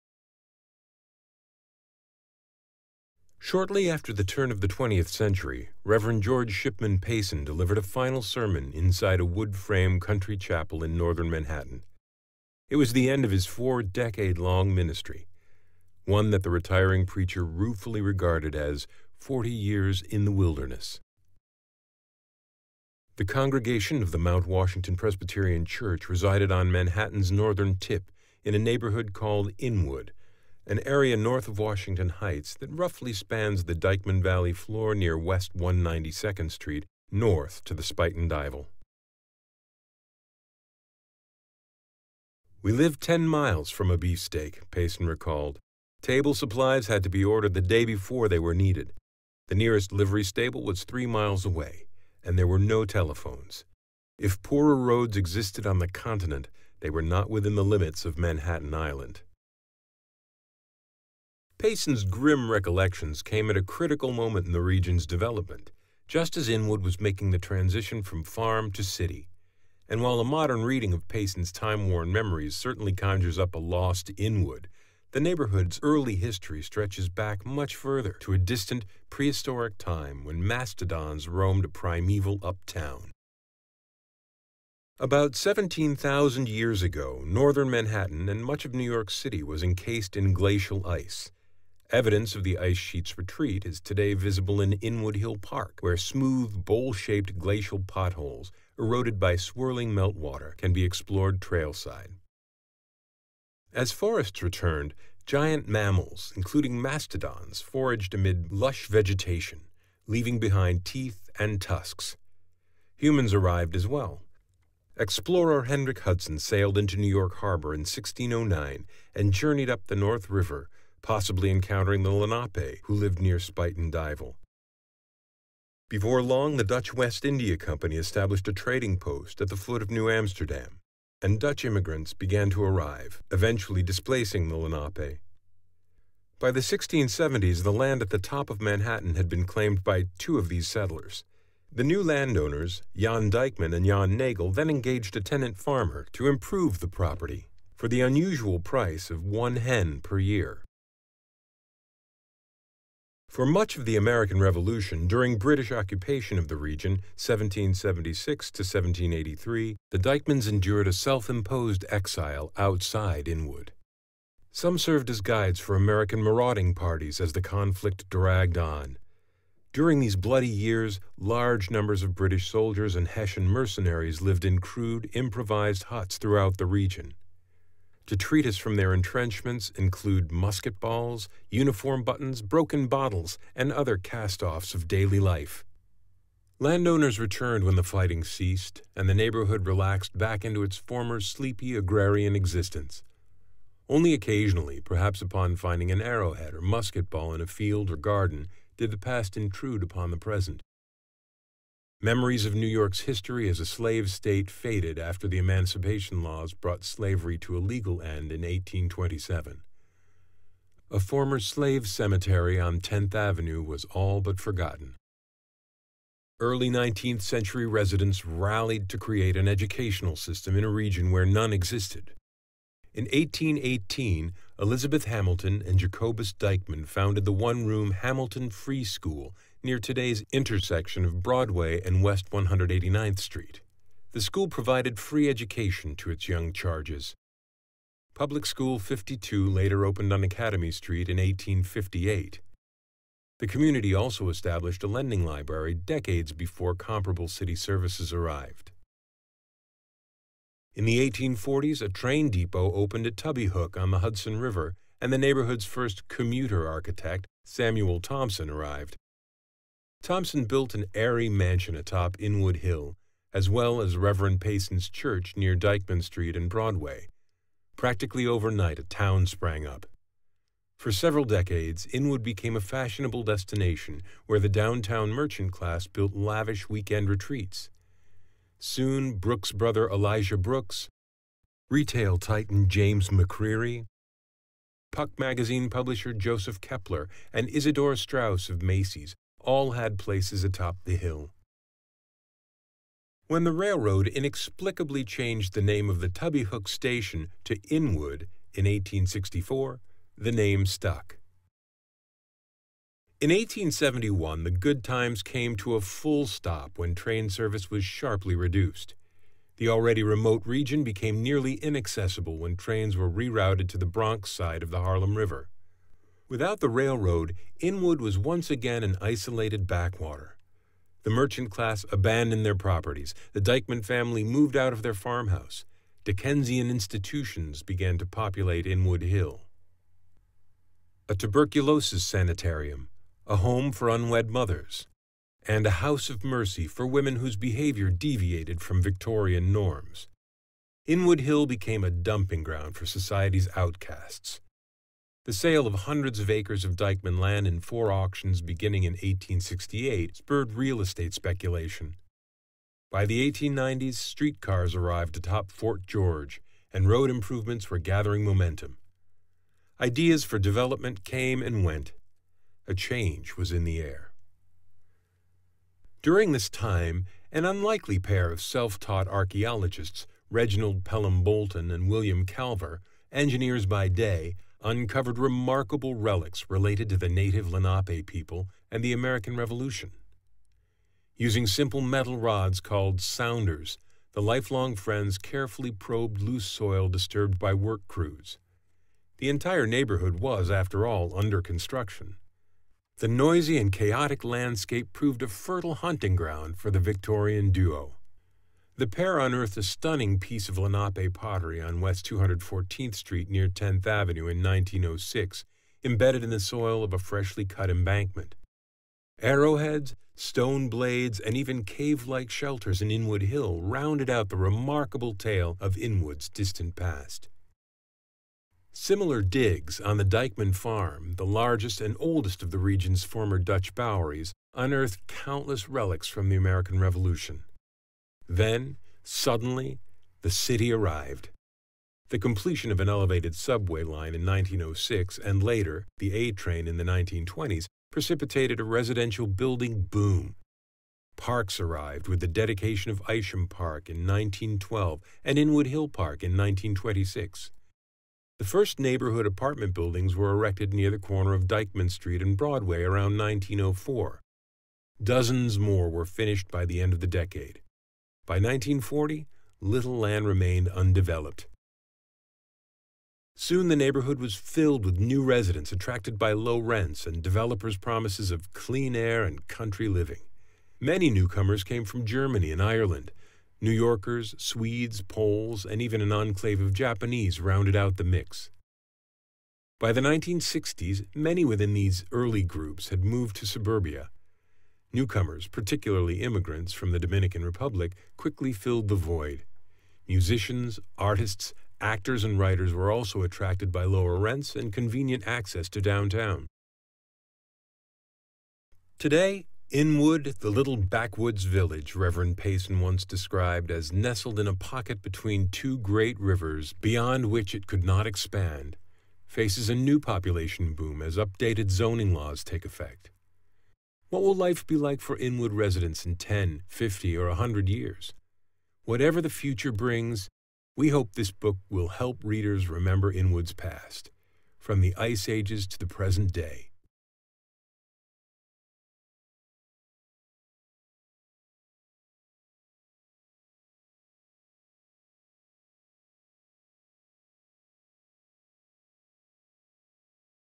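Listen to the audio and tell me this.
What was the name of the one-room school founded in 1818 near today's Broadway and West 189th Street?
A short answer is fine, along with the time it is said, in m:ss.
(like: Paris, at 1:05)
Hamilton Free School, at 3:47.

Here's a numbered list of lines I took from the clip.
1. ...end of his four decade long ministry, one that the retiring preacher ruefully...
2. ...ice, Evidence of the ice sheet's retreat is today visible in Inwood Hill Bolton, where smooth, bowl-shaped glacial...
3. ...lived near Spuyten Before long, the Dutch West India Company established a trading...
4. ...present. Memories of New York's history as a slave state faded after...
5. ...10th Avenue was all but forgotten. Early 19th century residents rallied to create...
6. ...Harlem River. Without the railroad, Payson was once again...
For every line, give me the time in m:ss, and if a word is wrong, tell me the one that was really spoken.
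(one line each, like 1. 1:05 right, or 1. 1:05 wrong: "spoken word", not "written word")
1. 0:13 right
2. 1:30 wrong: "Park", not "Bolton"
3. 2:02 right
4. 3:20 right
5. 3:32 right
6. 5:14 wrong: "Inwood", not "Payson".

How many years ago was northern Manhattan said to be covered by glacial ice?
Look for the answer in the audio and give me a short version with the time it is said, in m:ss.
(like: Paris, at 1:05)
17,000, at 1:25.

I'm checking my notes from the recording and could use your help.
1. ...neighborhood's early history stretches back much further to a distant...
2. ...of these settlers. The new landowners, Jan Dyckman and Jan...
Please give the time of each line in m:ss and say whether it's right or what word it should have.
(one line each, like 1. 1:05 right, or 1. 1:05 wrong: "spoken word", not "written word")
1. 1:15 right
2. 2:20 right.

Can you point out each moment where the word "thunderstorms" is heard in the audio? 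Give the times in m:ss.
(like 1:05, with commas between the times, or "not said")
not said.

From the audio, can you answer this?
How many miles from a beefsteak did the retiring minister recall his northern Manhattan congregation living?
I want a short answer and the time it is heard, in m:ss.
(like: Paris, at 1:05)
10, at 0:43.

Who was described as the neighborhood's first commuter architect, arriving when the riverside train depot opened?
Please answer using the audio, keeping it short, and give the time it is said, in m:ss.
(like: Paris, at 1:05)
Samuel Thompson, at 4:17.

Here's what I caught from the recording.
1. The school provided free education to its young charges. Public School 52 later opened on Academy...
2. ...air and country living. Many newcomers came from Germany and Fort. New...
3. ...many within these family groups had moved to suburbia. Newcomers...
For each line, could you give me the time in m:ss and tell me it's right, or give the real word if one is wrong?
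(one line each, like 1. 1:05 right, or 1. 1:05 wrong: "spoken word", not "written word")
1. 3:54 right
2. 7:48 wrong: "Ireland", not "Fort"
3. 8:01 wrong: "early", not "family".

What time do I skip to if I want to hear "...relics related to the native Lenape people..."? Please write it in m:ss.
6:15.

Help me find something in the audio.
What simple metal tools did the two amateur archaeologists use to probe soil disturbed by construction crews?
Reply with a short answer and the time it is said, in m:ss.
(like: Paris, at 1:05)
sounders, at 6:23.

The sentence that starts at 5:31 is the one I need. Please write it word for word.
A tuberculosis sanitarium, a home for unwed mothers, and a house of mercy for women whose behavior deviated from Victorian norms.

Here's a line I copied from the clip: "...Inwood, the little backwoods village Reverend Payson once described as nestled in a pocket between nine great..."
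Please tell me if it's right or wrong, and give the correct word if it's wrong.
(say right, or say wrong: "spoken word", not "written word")
wrong: "two", not "nine".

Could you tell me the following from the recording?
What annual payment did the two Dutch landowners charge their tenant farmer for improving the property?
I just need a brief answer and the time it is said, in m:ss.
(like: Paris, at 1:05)
one hen per year, at 2:29.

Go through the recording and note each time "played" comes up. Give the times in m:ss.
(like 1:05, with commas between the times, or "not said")
not said.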